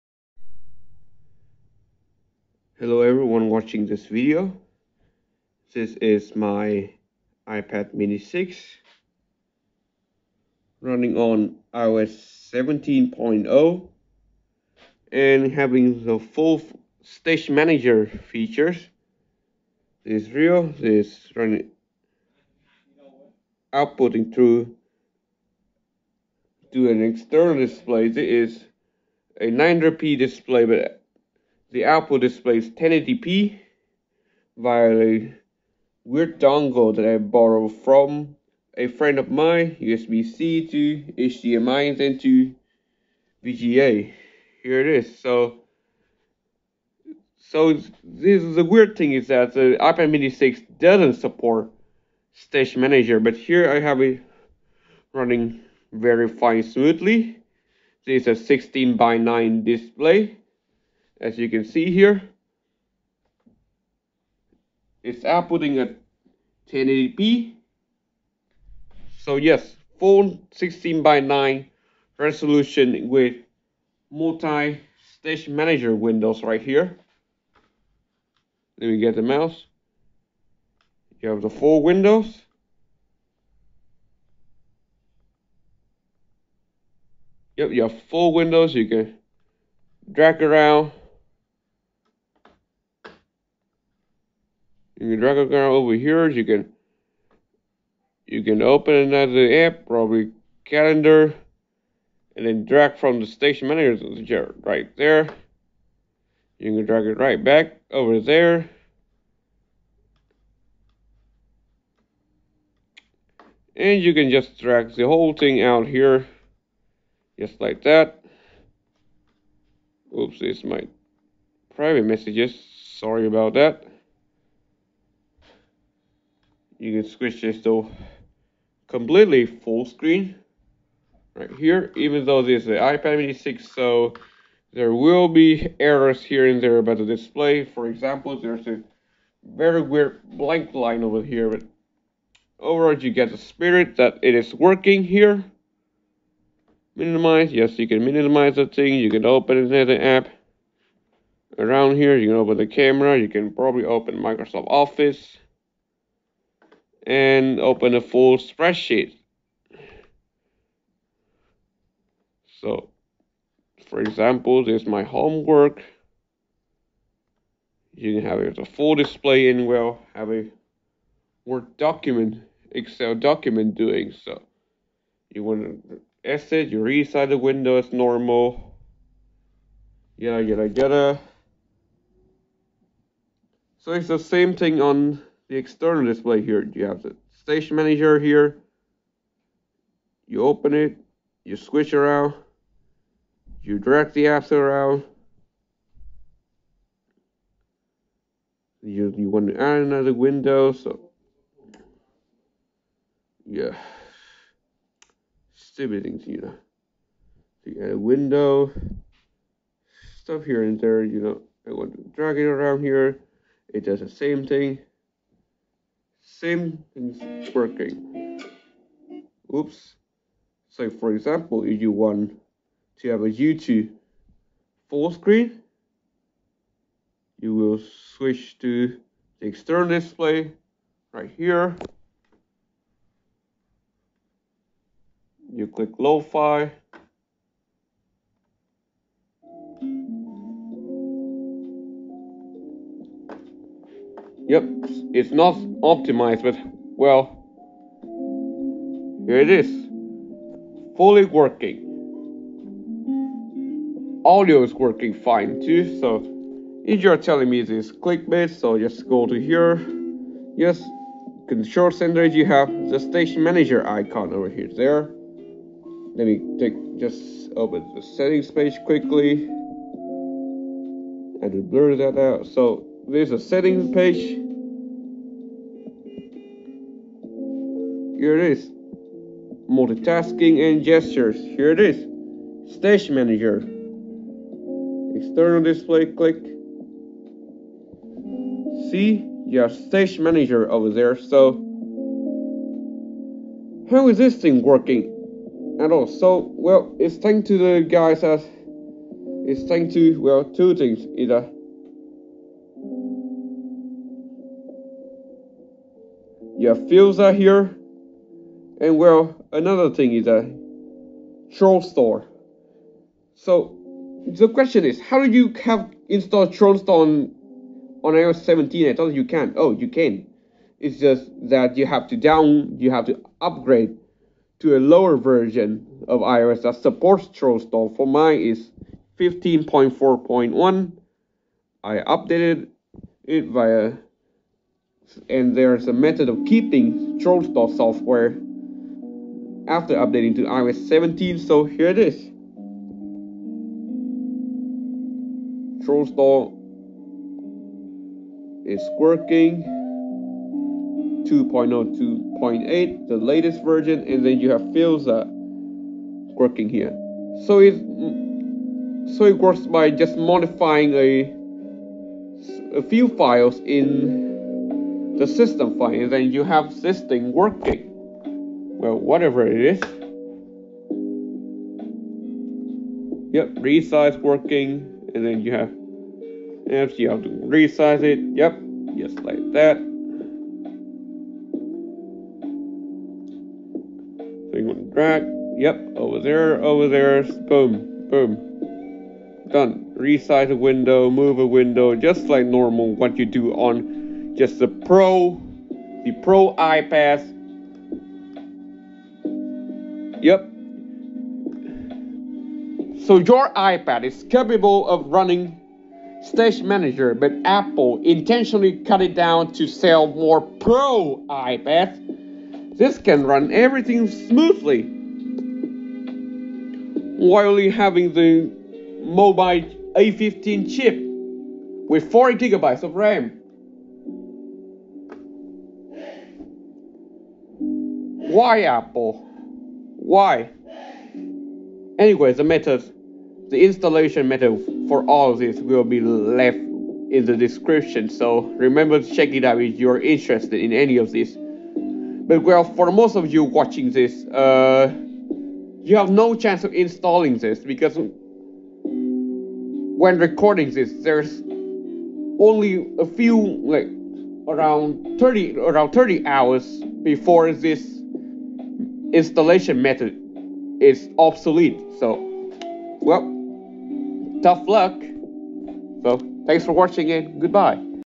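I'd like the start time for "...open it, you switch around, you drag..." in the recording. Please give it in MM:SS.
03:10.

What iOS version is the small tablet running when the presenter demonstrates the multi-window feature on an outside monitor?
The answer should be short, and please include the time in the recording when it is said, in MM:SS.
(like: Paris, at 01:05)
17.0, at 00:11.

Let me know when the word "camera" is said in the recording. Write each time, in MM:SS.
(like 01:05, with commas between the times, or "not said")
02:32.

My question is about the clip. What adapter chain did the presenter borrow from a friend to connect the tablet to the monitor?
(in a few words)
USB-C to HDMI into VGA.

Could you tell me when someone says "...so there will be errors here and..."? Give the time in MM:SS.
02:13.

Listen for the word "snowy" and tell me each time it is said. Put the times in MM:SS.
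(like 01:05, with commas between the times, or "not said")
not said.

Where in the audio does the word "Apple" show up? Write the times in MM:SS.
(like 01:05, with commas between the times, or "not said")
06:47, 07:08.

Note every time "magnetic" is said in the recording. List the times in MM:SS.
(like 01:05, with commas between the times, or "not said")
not said.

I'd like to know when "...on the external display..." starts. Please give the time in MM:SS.
03:04.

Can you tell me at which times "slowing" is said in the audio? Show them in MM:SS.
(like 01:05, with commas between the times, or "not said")
not said.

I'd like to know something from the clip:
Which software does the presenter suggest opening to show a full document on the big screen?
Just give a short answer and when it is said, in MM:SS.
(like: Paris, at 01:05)
Microsoft Office, at 02:34.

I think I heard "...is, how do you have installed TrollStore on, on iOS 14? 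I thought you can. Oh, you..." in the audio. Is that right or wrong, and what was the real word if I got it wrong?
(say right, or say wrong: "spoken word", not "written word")
wrong: "17", not "14".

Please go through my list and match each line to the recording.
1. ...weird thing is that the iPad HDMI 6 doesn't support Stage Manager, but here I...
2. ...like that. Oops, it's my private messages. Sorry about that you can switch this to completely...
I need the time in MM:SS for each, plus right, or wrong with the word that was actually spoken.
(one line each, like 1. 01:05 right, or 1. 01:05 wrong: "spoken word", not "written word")
1. 00:48 wrong: "Mini", not "HDMI"
2. 01:57 right.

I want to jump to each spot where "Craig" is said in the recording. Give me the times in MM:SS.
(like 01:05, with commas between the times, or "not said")
not said.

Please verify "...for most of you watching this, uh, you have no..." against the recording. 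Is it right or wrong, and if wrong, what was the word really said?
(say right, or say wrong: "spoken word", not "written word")
right.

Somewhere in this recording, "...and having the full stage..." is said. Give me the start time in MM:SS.
00:15.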